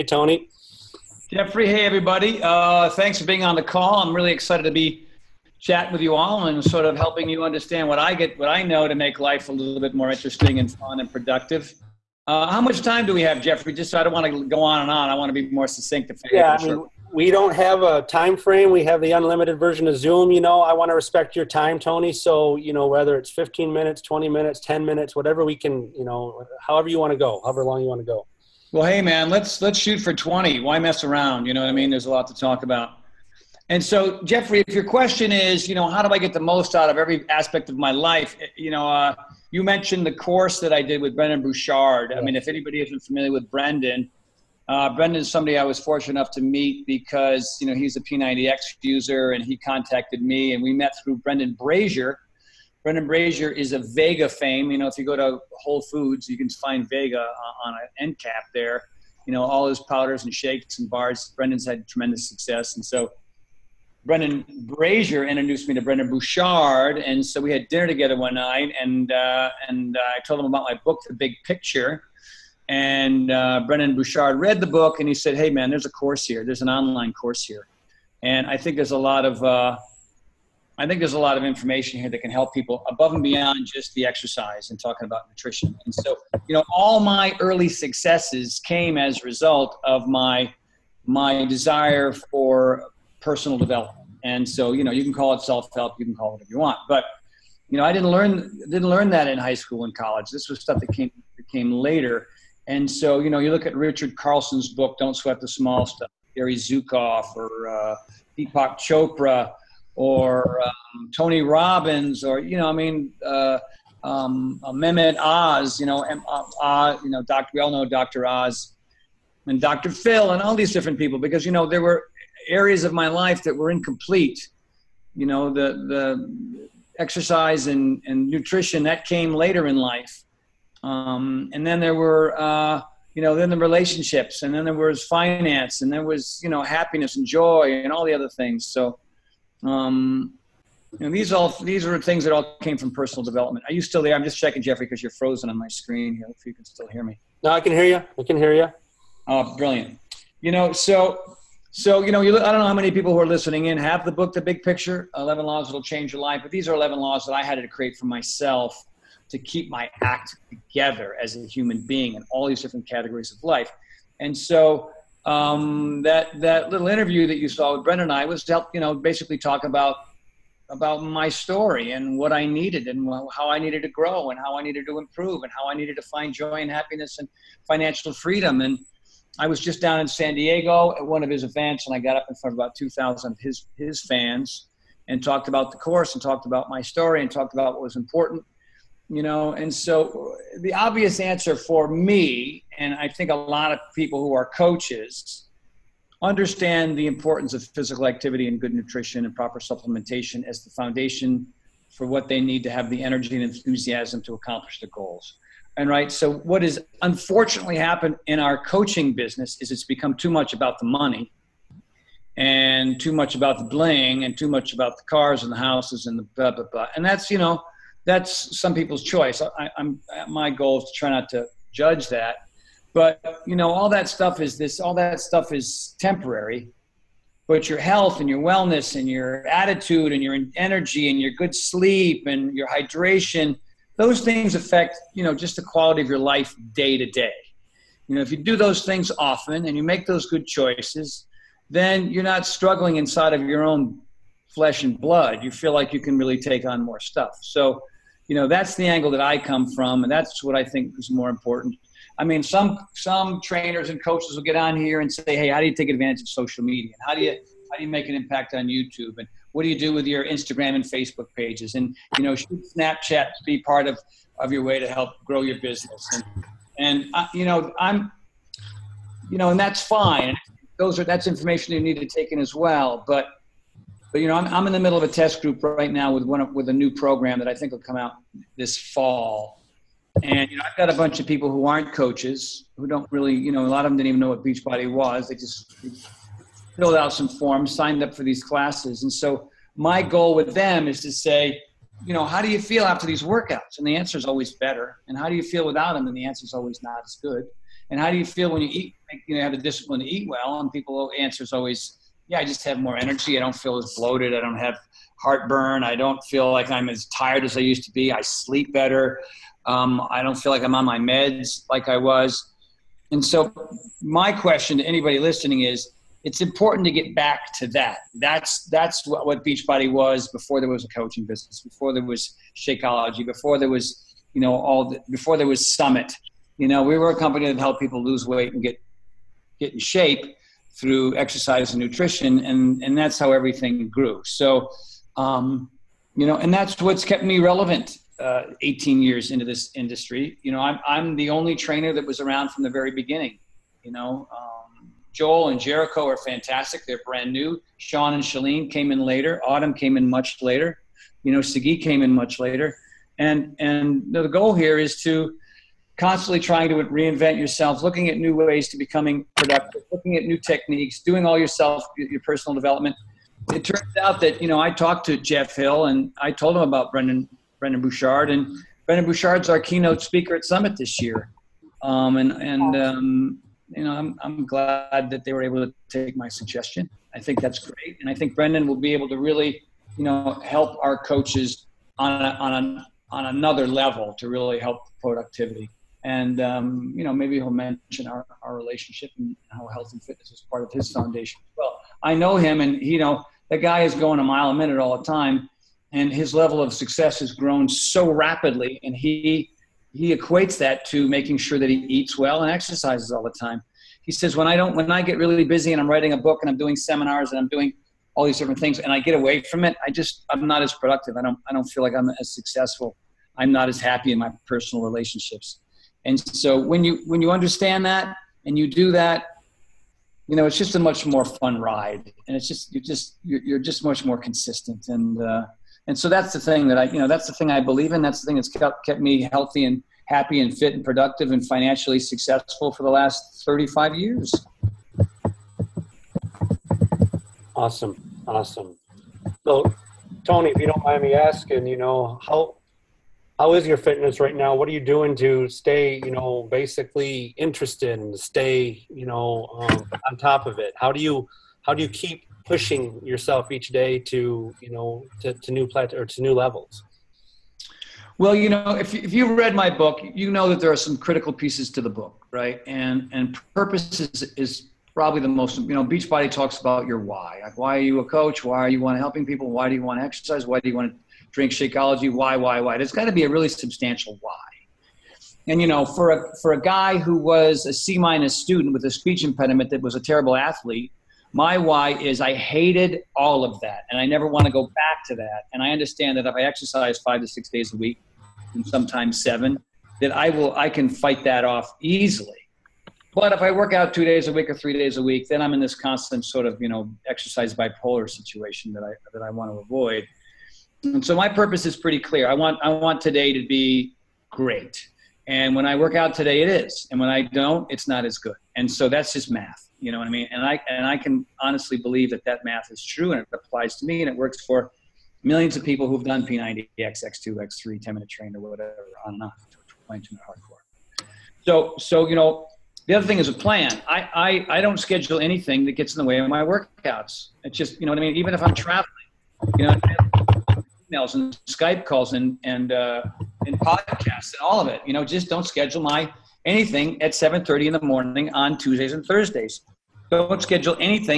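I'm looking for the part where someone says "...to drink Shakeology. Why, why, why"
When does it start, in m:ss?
7:50.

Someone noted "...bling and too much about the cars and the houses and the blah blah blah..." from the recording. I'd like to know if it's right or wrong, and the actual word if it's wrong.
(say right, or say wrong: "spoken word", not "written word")
right.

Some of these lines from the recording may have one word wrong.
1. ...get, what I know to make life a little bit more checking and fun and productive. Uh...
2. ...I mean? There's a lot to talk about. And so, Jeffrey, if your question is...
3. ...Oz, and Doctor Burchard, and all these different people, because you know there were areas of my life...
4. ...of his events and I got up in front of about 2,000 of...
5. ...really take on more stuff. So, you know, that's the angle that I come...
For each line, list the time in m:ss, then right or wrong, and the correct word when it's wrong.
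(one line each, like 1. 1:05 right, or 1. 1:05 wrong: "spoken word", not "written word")
1. 0:08 wrong: "interesting", not "checking"
2. 0:31 right
3. 1:58 wrong: "Phil", not "Burchard"
4. 3:01 right
5. 4:06 right.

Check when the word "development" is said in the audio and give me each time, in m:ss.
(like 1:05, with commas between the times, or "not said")
1:33, 2:23, 6:02.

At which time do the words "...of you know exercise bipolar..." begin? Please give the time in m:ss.
8:16.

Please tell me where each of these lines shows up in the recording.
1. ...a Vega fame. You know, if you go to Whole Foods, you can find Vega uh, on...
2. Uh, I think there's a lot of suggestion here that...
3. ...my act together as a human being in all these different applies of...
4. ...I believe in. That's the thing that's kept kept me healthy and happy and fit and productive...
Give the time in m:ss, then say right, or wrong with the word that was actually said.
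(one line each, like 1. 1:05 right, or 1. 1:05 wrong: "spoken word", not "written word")
1. 0:53 right
2. 1:19 wrong: "information", not "suggestion"
3. 2:39 wrong: "categories", not "applies"
4. 7:07 right.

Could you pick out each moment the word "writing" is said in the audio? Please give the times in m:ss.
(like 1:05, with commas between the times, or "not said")
6:45.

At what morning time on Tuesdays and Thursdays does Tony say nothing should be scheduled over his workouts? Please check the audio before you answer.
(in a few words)
7:30.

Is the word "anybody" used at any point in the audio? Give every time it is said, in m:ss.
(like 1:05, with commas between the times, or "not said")
0:42, 5:14.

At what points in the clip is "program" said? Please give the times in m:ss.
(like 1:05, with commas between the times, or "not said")
4:36.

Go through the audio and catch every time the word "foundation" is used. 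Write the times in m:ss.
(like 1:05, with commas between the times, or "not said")
3:20, 6:30.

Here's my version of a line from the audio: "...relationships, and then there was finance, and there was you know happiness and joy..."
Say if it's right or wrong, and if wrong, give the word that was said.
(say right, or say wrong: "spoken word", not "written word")
right.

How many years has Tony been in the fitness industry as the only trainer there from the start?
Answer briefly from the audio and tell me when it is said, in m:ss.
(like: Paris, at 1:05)
18, at 5:38.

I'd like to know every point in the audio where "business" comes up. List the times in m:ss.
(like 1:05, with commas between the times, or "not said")
3:29, 4:25, 5:21.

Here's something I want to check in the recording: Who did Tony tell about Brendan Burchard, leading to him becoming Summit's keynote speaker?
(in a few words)
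Jeff Hill.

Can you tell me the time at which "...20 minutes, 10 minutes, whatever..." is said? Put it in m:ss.
0:24.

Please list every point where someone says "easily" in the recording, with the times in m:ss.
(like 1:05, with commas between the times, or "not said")
8:11.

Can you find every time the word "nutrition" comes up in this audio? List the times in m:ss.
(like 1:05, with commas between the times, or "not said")
1:25, 2:08, 3:18, 5:31.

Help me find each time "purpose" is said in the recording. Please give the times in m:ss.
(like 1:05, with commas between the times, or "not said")
7:43, 8:21.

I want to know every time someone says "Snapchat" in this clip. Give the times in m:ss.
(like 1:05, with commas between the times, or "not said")
4:22.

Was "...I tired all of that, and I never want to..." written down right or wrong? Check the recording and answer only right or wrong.
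wrong.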